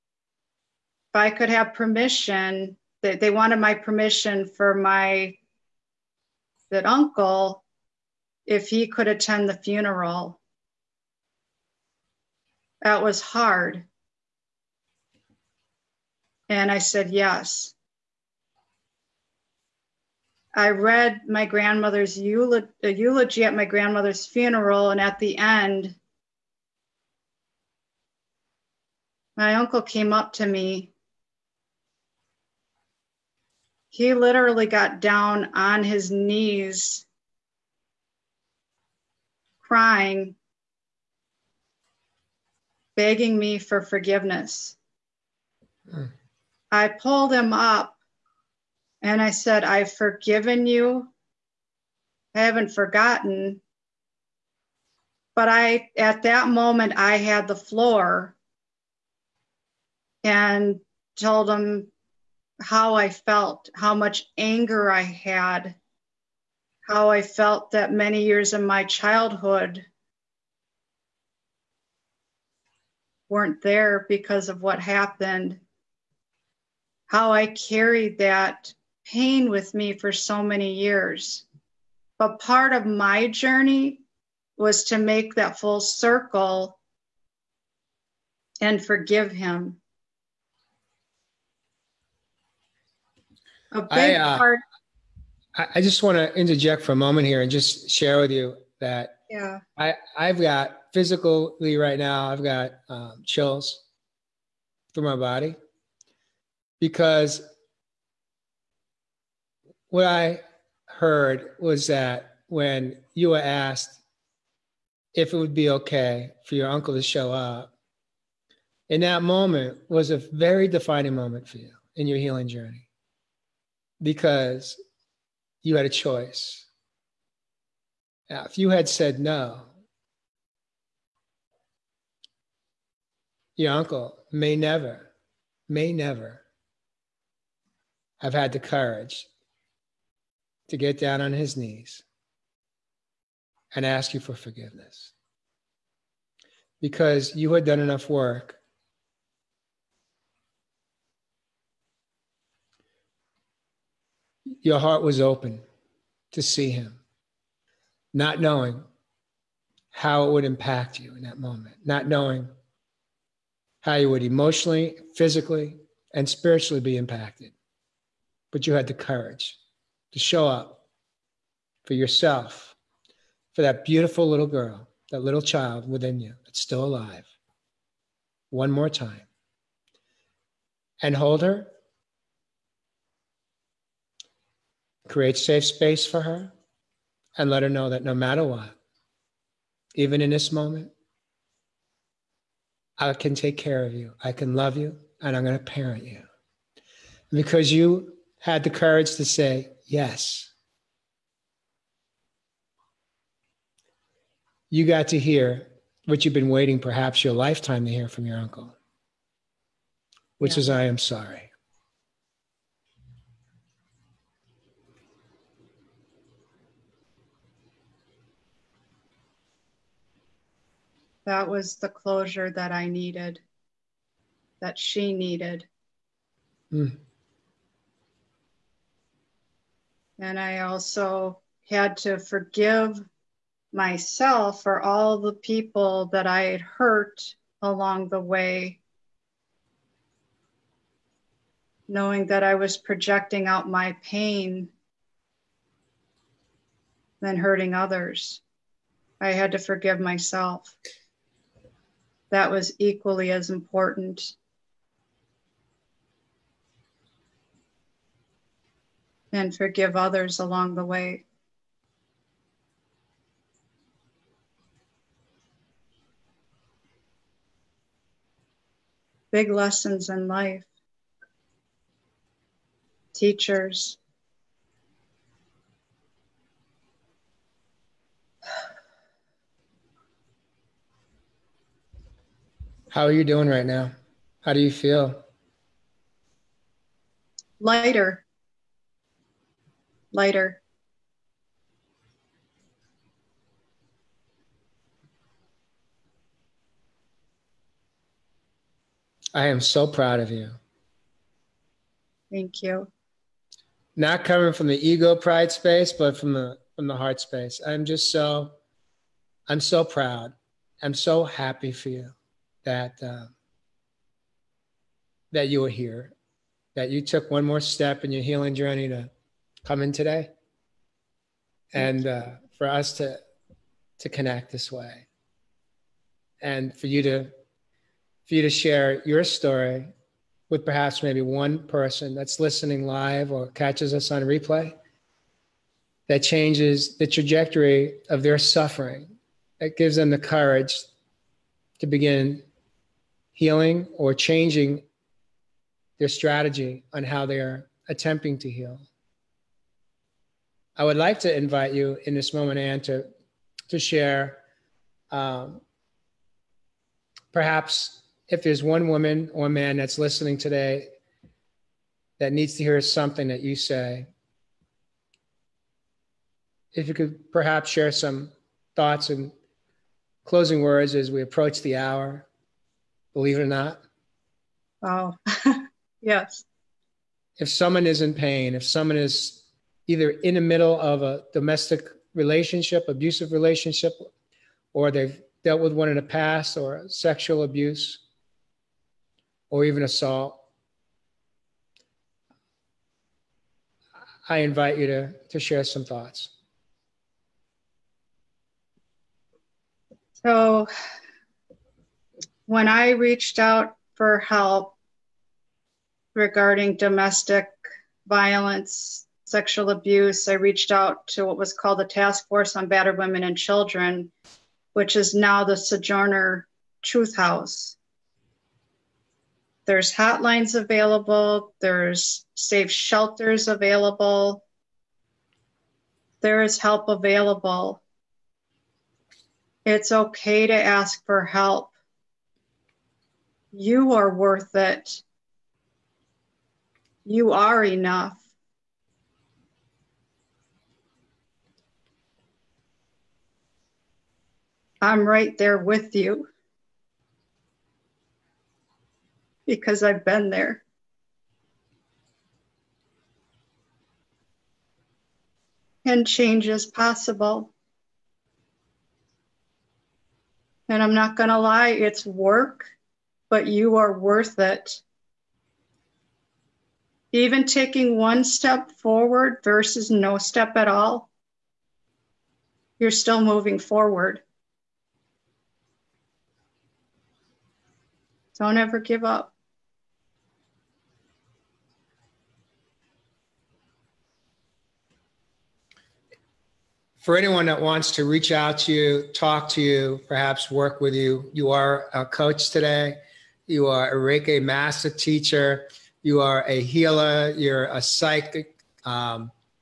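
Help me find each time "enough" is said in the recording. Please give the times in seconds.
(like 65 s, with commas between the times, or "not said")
147 s, 437 s.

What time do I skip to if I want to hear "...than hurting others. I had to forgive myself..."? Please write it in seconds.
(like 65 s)
247 s.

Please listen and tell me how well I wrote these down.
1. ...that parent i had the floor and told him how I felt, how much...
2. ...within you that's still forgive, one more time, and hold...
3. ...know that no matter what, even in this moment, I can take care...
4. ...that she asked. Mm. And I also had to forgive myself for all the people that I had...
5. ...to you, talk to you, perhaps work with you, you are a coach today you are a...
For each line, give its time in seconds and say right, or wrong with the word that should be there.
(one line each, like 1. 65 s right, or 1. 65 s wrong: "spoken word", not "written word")
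1. 56 s wrong: "moment", not "parent"
2. 175 s wrong: "alive", not "forgive"
3. 187 s right
4. 224 s wrong: "needed", not "asked"
5. 488 s right.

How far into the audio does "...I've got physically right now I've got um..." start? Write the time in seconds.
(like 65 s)
100 s.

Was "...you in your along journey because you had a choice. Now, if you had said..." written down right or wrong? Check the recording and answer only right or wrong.
wrong.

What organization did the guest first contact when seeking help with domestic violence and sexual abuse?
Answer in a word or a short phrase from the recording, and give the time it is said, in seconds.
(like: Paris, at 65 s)
Task Force on Battered Women and Children, at 411 s.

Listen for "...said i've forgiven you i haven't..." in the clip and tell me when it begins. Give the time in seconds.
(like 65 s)
49 s.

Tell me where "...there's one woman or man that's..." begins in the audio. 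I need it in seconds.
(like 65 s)
358 s.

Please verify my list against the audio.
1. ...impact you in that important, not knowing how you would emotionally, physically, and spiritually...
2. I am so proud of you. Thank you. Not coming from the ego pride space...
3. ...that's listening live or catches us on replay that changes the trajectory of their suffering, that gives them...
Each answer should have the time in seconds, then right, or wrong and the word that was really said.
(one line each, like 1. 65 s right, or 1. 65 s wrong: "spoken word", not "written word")
1. 160 s wrong: "moment", not "important"
2. 299 s right
3. 332 s right.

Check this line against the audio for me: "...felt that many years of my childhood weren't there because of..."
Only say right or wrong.
right.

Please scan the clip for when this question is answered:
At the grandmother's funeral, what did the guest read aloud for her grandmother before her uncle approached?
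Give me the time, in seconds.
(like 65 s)
22 s.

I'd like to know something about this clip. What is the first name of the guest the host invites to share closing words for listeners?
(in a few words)
Ann.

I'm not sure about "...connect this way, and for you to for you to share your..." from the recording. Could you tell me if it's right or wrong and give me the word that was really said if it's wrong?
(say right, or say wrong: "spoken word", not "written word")
right.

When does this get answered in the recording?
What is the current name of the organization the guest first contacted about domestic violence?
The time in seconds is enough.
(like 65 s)
415 s.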